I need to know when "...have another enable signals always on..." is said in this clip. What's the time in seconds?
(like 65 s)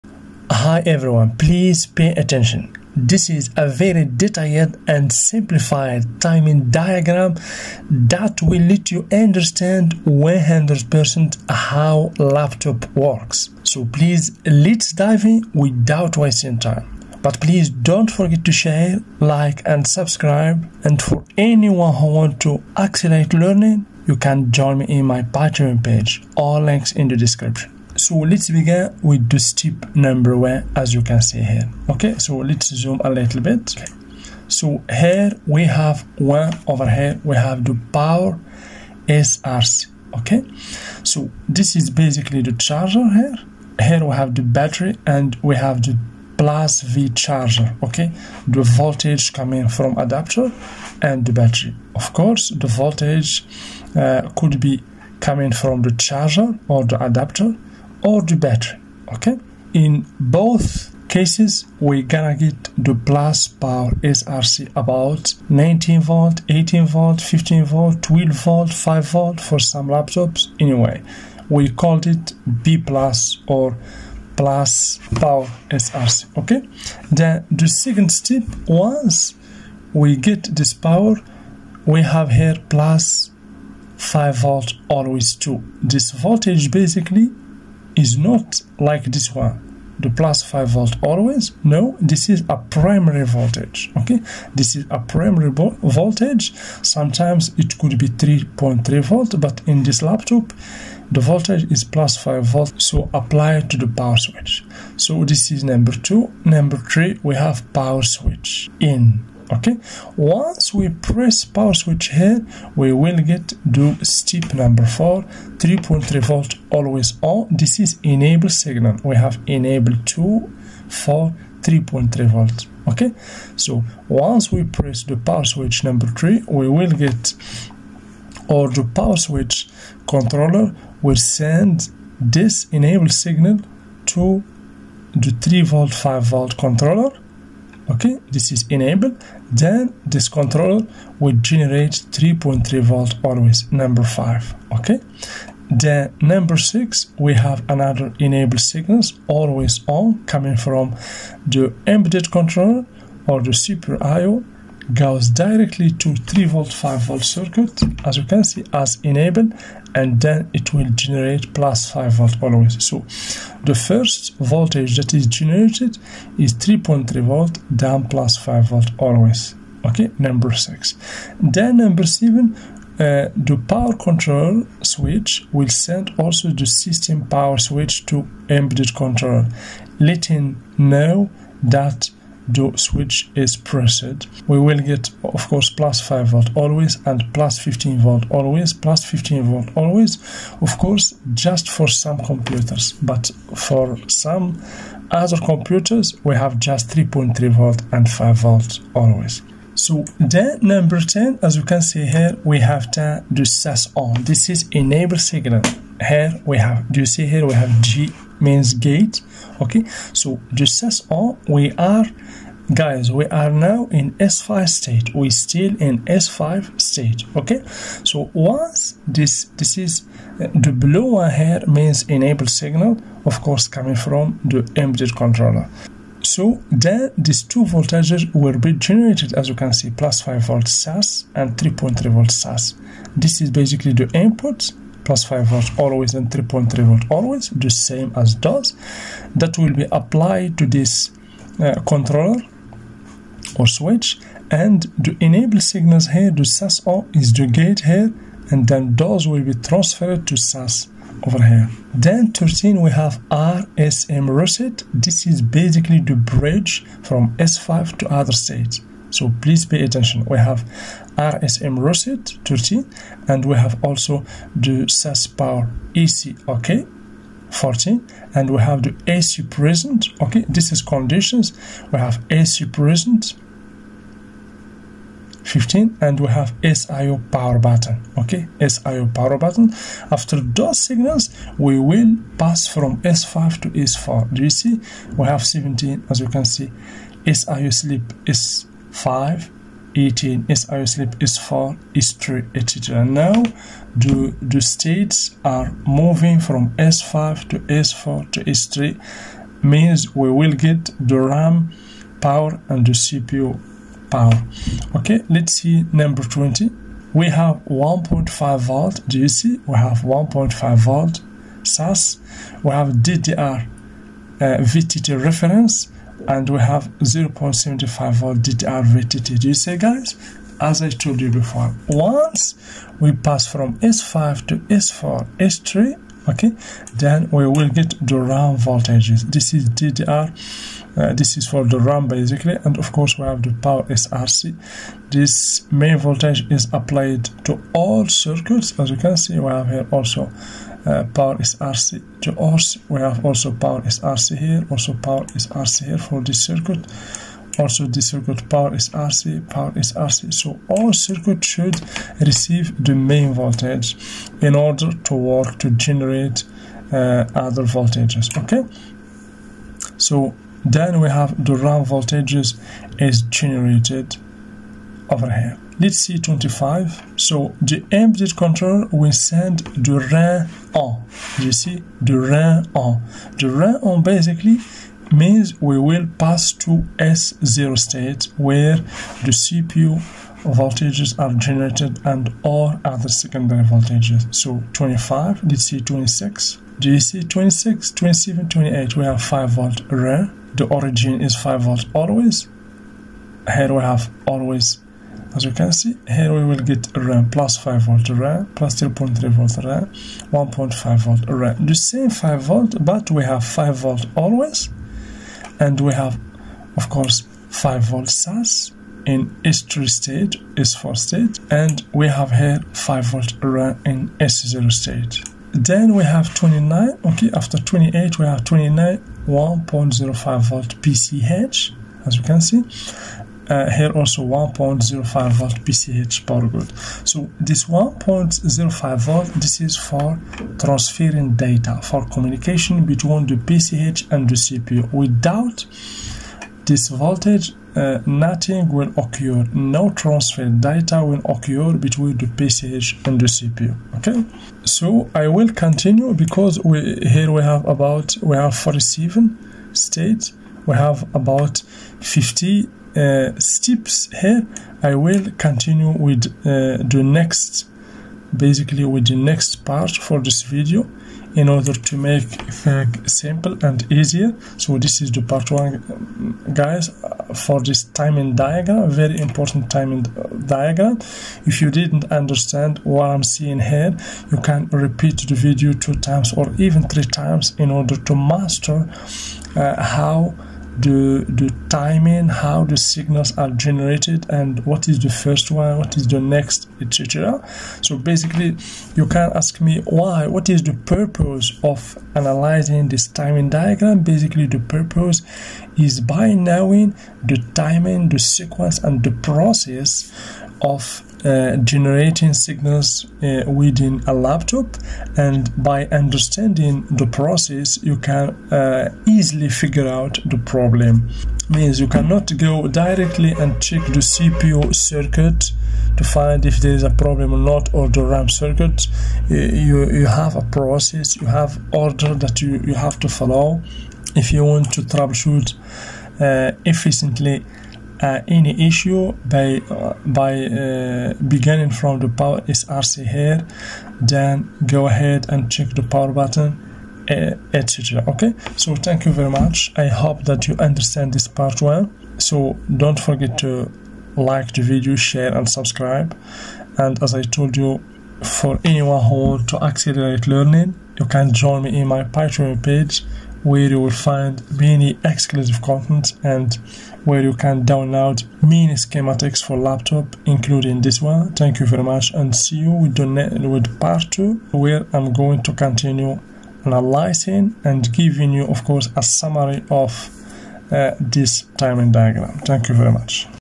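147 s.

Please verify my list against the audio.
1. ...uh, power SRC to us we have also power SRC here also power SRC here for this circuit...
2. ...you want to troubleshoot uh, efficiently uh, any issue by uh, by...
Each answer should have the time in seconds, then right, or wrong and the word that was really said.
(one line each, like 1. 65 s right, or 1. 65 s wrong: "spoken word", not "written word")
1. 340 s right
2. 524 s right.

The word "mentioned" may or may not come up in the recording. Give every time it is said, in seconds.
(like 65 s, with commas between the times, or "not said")
not said.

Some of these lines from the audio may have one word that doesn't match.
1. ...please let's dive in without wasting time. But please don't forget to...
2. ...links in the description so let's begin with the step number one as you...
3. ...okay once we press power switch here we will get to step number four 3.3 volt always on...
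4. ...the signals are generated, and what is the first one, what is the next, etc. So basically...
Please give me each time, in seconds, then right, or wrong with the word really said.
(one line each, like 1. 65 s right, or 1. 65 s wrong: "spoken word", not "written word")
1. 13 s right
2. 26 s right
3. 109 s right
4. 482 s right.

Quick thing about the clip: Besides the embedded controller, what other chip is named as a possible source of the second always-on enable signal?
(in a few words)
super IO.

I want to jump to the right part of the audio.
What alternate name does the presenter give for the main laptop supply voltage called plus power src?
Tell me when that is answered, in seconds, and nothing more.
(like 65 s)
72 s.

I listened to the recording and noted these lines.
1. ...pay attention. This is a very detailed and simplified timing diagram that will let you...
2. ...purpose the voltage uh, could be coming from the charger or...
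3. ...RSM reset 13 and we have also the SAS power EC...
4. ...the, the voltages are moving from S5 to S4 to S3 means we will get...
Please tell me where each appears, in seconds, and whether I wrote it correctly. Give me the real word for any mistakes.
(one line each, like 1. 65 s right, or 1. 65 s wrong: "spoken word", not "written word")
1. 1 s right
2. 52 s wrong: "course", not "purpose"
3. 261 s right
4. 293 s wrong: "states", not "voltages".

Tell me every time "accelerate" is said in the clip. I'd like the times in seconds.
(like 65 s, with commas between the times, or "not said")
22 s, 549 s.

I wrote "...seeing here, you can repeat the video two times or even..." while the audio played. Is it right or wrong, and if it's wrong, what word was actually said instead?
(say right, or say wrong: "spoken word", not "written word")
right.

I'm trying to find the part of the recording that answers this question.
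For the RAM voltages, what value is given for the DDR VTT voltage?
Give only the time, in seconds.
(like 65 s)
316 s.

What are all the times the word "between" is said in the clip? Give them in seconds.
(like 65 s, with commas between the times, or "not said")
432 s, 441 s.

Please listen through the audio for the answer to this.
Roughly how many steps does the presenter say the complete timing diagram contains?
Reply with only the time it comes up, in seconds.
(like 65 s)
451 s.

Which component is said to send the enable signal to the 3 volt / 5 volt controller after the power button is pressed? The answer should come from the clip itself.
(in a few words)
power switch controller.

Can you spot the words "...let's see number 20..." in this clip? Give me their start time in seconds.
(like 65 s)
305 s.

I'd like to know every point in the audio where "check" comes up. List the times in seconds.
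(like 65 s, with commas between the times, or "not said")
513 s, 535 s.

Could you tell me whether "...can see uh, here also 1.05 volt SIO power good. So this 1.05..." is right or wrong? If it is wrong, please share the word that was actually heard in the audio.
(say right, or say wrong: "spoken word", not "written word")
wrong: "PCH", not "SIO".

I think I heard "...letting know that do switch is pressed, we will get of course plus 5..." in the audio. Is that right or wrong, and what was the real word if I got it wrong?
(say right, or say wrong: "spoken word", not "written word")
right.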